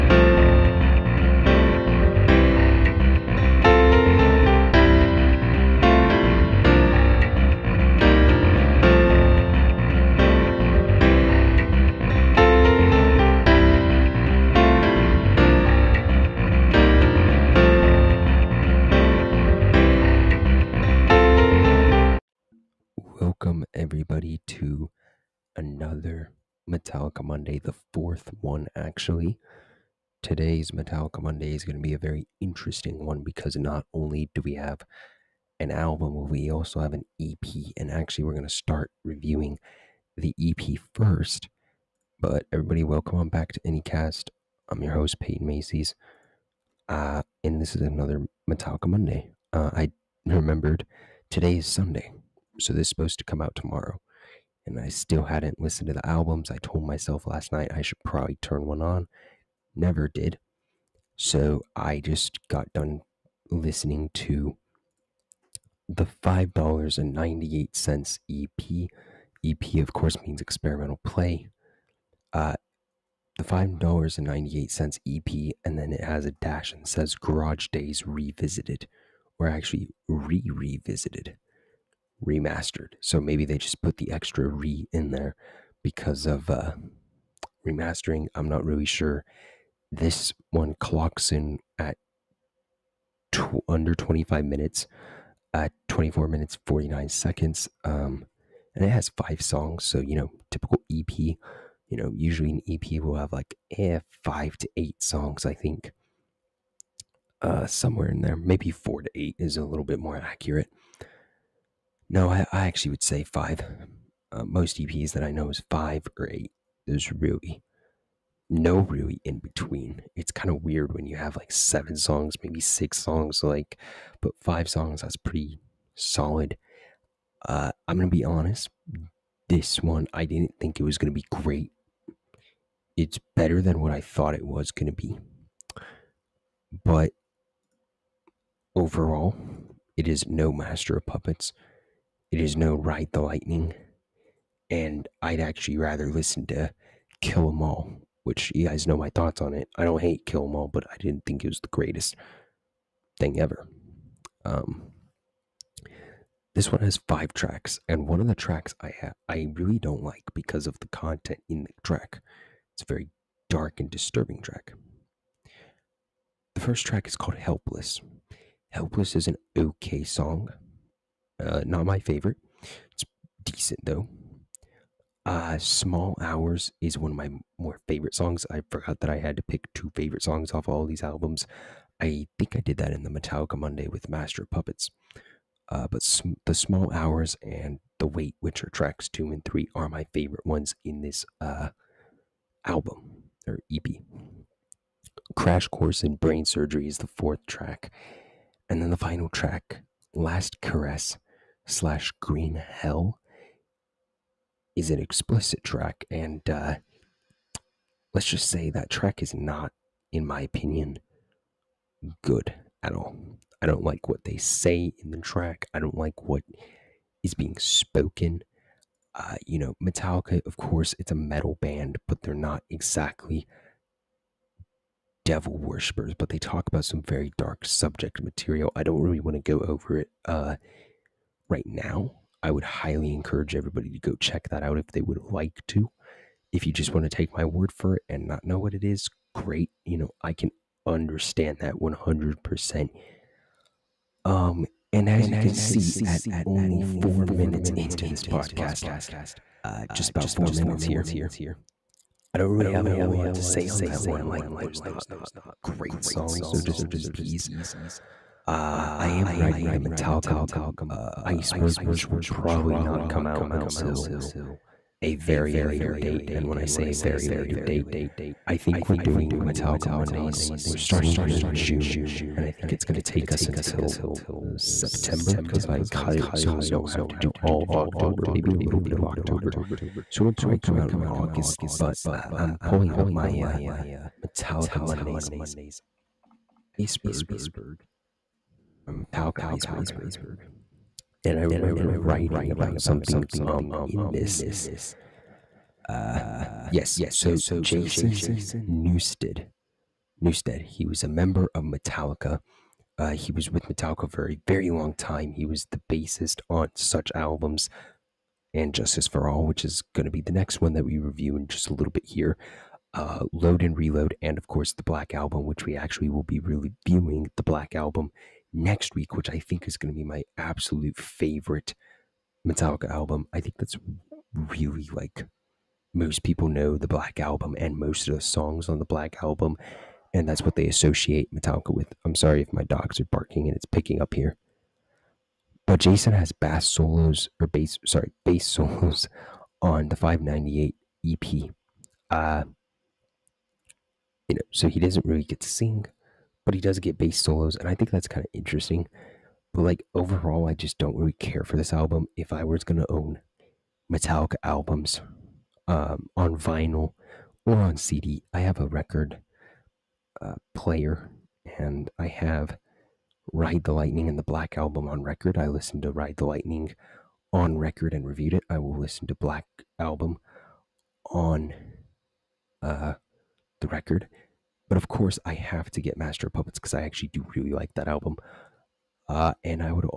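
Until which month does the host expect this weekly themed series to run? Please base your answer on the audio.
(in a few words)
September.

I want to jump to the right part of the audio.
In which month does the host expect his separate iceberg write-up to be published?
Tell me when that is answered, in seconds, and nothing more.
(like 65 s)
281 s.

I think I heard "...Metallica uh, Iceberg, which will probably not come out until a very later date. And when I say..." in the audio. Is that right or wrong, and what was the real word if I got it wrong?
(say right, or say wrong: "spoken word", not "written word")
right.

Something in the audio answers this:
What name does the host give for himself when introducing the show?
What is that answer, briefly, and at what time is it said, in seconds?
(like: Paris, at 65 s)
Peyton Macy's, at 45 s.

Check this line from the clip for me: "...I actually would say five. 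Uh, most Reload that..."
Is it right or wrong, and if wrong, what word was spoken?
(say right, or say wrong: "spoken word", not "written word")
wrong: "EPs", not "Reload".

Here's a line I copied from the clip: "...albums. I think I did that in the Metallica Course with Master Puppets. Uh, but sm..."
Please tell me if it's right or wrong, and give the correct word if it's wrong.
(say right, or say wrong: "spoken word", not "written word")
wrong: "Monday", not "Course".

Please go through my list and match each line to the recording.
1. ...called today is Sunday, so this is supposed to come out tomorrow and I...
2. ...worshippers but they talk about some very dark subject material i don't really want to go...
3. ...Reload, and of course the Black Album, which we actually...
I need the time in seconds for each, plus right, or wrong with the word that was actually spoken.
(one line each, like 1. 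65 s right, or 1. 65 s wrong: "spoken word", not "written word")
1. 50 s wrong: "remembered", not "called"
2. 225 s right
3. 313 s right.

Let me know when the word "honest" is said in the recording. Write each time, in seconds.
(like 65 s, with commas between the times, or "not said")
128 s.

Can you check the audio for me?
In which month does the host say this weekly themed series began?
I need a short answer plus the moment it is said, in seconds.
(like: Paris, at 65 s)
June, at 271 s.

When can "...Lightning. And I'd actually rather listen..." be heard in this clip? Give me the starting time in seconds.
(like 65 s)
143 s.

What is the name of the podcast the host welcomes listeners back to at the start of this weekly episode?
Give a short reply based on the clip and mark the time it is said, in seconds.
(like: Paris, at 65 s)
AnyCast, at 43 s.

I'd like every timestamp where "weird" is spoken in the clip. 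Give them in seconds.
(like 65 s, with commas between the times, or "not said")
120 s.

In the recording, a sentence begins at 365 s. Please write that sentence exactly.
I listened to Ride the Lightning on record and reviewed it.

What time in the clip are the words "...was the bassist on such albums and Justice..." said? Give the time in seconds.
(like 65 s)
305 s.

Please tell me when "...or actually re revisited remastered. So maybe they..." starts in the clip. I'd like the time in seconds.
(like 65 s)
79 s.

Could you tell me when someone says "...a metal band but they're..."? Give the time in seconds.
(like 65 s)
221 s.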